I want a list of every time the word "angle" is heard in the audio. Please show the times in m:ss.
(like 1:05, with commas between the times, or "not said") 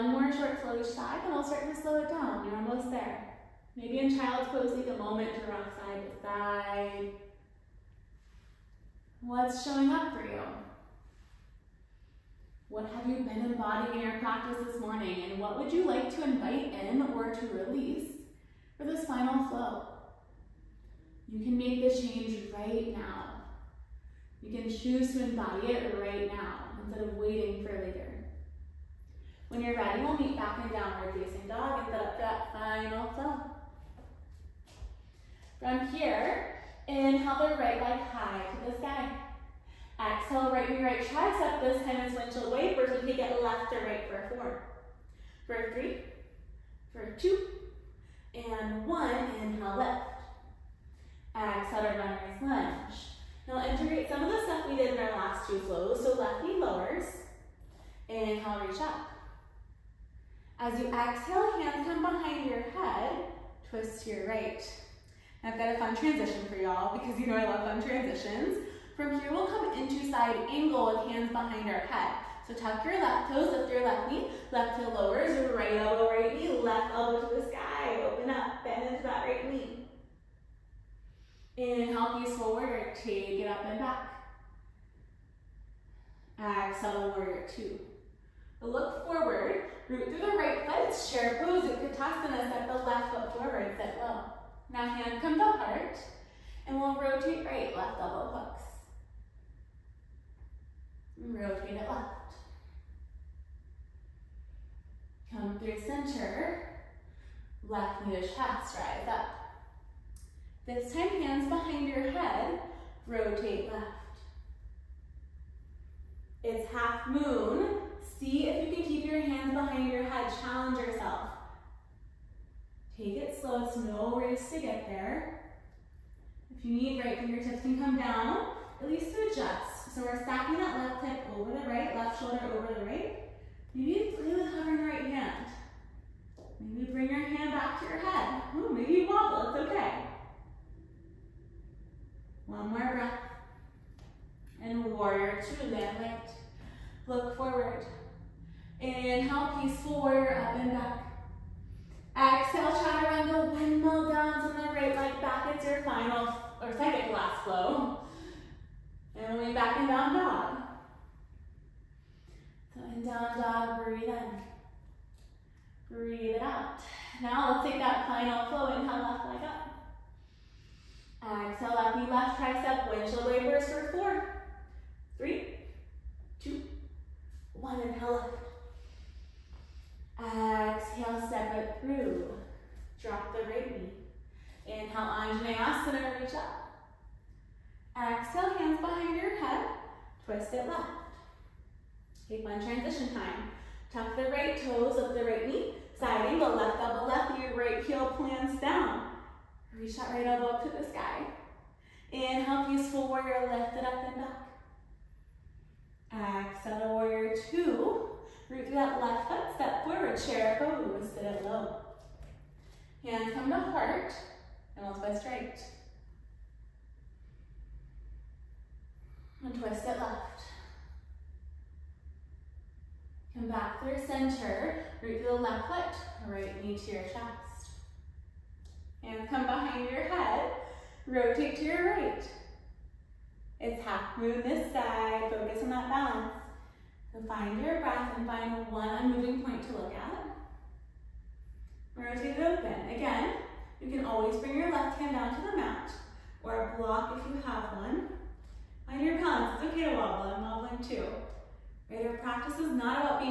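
1:10, 3:16.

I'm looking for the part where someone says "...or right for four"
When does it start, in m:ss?
0:43.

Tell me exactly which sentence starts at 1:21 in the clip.
Inhale, peace warrior, take it up and back.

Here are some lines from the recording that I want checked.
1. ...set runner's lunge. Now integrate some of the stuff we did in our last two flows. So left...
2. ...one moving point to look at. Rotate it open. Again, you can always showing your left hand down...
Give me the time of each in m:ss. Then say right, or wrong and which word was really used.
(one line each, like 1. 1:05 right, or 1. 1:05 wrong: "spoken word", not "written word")
1. 0:51 right
2. 3:58 wrong: "bring", not "showing".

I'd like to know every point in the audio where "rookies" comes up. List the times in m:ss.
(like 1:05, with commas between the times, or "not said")
not said.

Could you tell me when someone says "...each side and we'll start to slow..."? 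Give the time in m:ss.
0:00.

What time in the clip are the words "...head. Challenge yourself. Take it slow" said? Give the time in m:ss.
2:00.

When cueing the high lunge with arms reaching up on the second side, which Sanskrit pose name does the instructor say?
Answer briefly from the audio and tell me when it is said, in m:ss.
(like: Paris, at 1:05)
Anjaneyasana, at 3:05.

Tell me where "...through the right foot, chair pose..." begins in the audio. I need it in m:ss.
1:30.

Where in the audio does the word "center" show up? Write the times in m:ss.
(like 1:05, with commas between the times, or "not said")
1:45, 3:44.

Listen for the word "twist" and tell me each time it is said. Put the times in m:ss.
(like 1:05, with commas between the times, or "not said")
1:03, 3:10, 3:34, 3:39.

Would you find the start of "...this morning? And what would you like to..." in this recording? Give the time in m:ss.
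0:14.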